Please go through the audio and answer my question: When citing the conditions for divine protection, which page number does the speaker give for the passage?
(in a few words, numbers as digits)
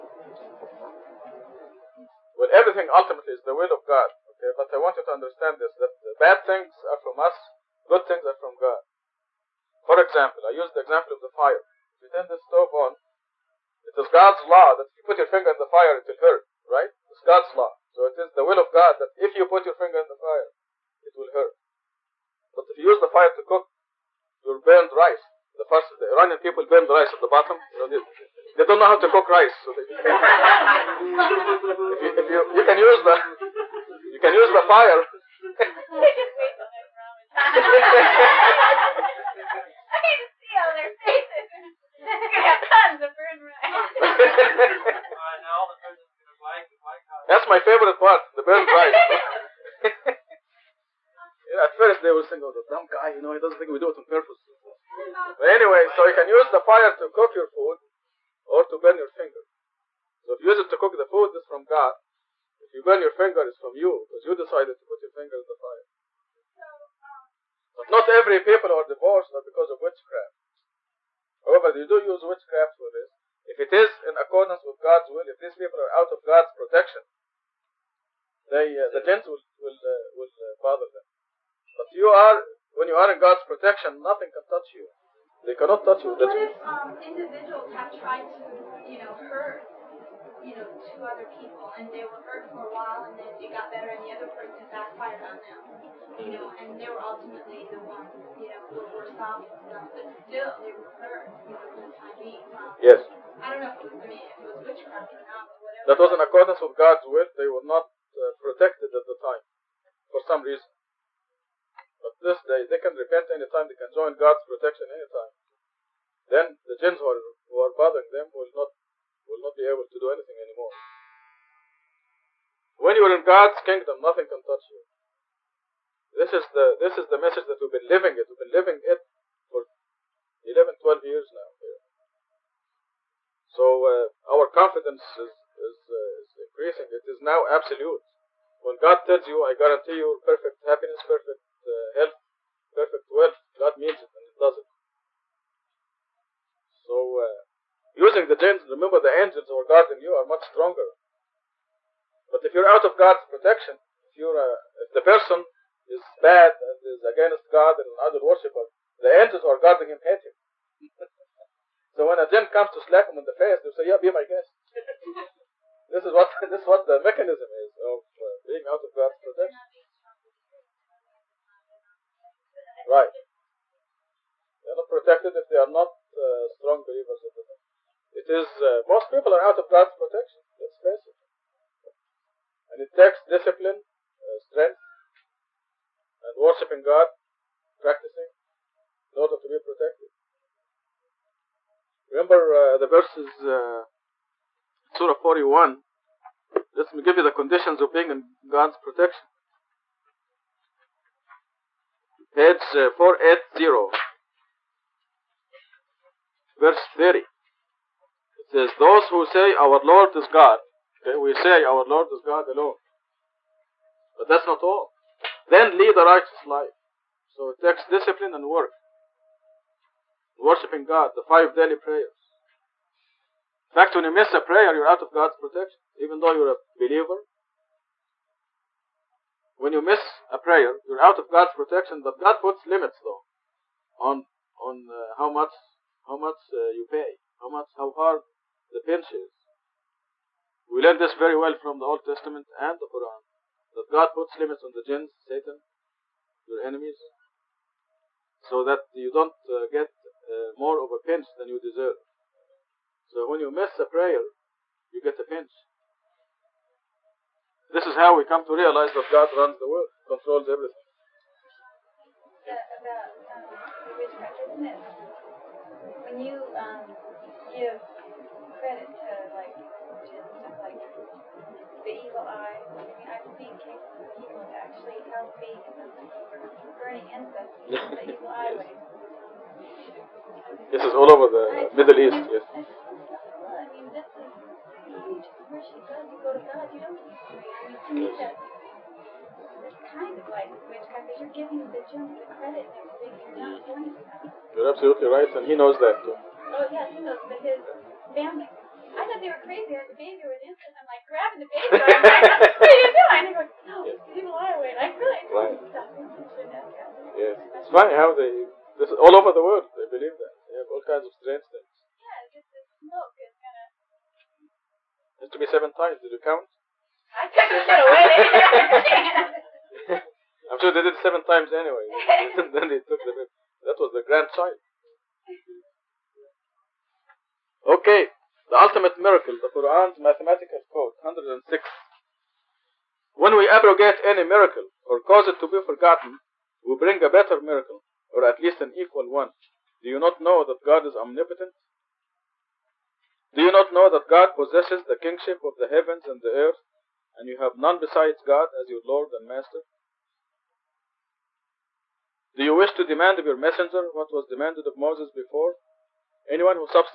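480.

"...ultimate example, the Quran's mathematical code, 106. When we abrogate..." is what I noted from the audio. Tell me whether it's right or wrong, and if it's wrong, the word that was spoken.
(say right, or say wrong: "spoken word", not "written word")
wrong: "miracle", not "example".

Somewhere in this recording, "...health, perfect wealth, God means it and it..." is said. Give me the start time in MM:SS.
02:21.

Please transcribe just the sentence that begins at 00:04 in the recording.
Okay, but I want you to understand this: that the bad things are from us, good things are from God.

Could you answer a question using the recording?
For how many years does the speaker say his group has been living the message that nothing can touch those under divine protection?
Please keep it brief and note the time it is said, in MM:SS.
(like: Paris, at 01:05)
11 or 12 years, at 02:10.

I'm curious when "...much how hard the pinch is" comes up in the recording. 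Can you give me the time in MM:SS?
03:57.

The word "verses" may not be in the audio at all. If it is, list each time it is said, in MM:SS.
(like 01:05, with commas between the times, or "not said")
03:12, 03:26.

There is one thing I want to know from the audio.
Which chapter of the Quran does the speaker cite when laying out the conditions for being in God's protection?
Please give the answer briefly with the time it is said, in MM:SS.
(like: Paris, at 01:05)
Surah 41, at 03:14.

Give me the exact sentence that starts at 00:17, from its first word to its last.
So it is the will of God that if you put your finger in the fire, it will hurt.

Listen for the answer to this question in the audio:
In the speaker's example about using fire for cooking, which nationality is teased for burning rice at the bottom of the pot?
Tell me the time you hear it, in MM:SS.
00:26.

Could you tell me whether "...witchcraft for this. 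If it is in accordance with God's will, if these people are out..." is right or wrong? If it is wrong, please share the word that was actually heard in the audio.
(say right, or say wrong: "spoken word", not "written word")
right.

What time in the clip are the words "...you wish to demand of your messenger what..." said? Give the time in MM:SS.
05:52.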